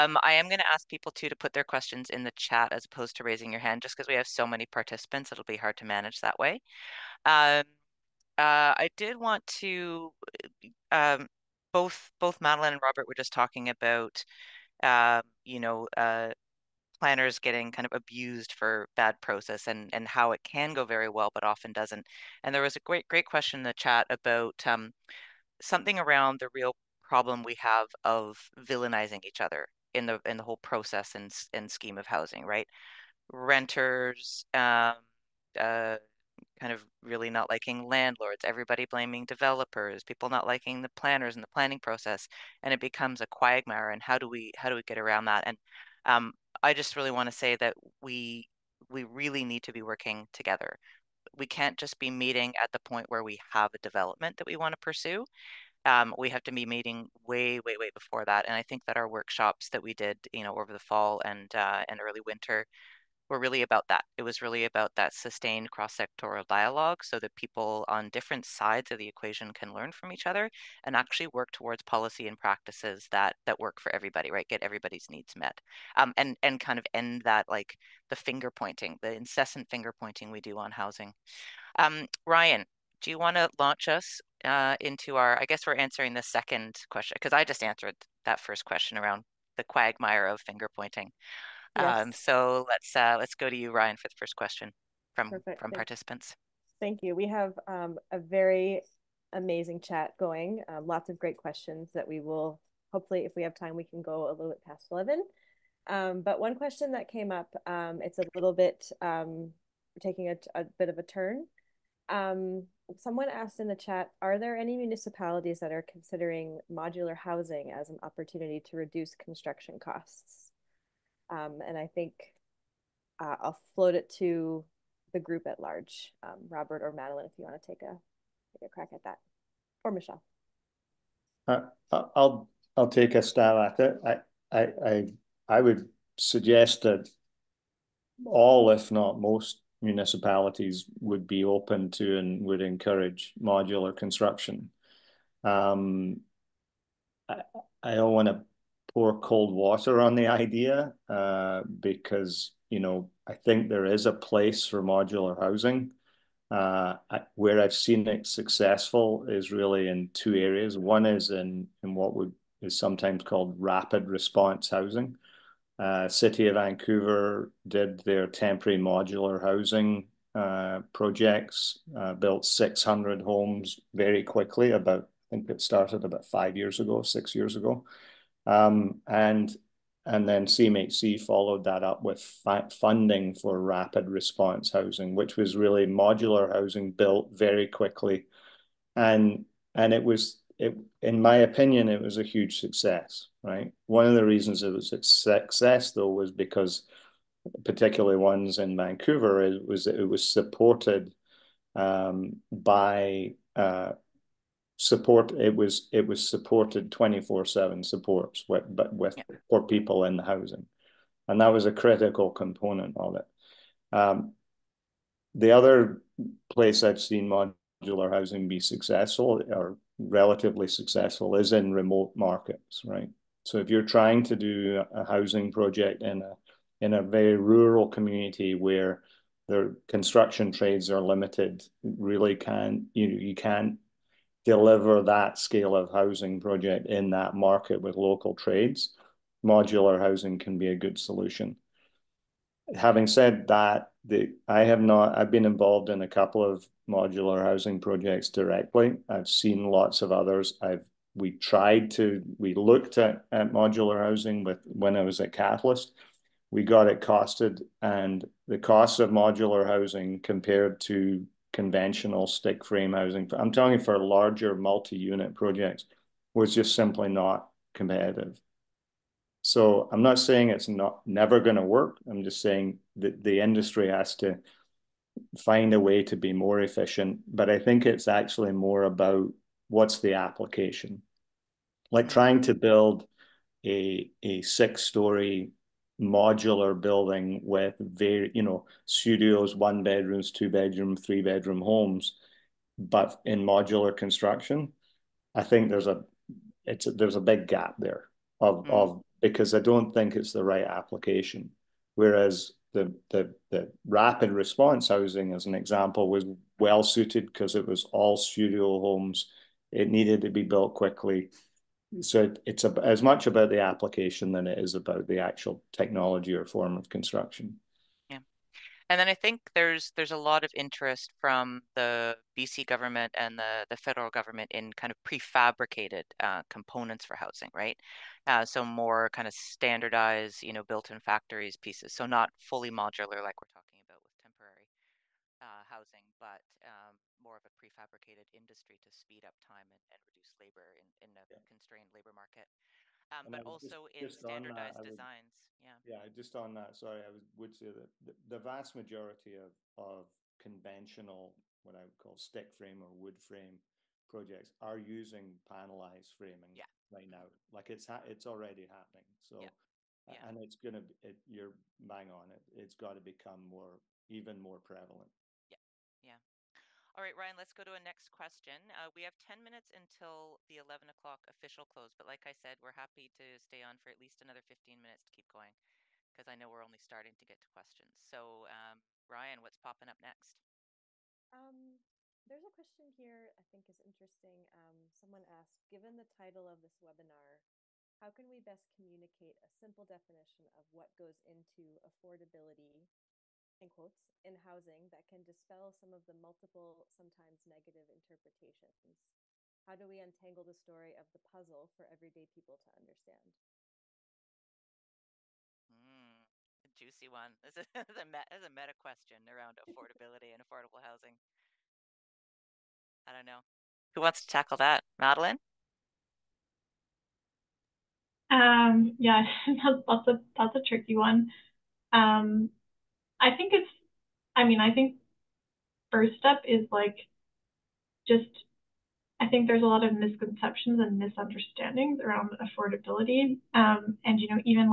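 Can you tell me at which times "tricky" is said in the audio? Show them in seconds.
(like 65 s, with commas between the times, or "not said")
420 s.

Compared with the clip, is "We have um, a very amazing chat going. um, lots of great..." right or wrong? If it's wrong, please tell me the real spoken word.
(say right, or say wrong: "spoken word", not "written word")
right.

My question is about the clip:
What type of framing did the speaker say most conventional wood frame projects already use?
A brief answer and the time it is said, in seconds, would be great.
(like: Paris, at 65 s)
Panelized framing, at 355 s.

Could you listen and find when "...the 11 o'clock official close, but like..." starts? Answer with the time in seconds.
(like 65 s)
370 s.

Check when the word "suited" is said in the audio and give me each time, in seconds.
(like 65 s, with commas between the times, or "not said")
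306 s.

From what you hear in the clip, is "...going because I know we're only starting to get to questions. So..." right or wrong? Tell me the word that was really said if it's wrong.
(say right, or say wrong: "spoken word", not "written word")
right.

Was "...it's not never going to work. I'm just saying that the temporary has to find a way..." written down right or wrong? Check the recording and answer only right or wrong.
wrong.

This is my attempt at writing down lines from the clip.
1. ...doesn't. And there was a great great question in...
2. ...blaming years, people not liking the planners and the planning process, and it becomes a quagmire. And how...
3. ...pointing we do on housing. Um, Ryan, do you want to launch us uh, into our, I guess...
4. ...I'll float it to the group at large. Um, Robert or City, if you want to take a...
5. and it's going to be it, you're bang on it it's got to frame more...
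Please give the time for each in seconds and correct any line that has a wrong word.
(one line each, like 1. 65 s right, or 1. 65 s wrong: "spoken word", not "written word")
1. 21 s right
2. 38 s wrong: "developers", not "years"
3. 79 s right
4. 123 s wrong: "Madeleine", not "City"
5. 360 s wrong: "become", not "frame".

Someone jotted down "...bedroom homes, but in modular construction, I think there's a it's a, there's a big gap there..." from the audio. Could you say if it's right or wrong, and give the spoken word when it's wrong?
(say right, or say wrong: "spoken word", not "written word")
right.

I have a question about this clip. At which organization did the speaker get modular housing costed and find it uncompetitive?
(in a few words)
Catalyst.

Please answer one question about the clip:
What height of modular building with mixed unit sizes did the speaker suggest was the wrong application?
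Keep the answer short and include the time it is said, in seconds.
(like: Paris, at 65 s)
6 storeys, at 284 s.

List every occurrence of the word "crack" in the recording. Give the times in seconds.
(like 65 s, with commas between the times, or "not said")
128 s.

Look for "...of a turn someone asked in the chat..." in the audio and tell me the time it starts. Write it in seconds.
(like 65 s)
110 s.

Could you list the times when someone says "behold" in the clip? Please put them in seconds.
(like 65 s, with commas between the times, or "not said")
not said.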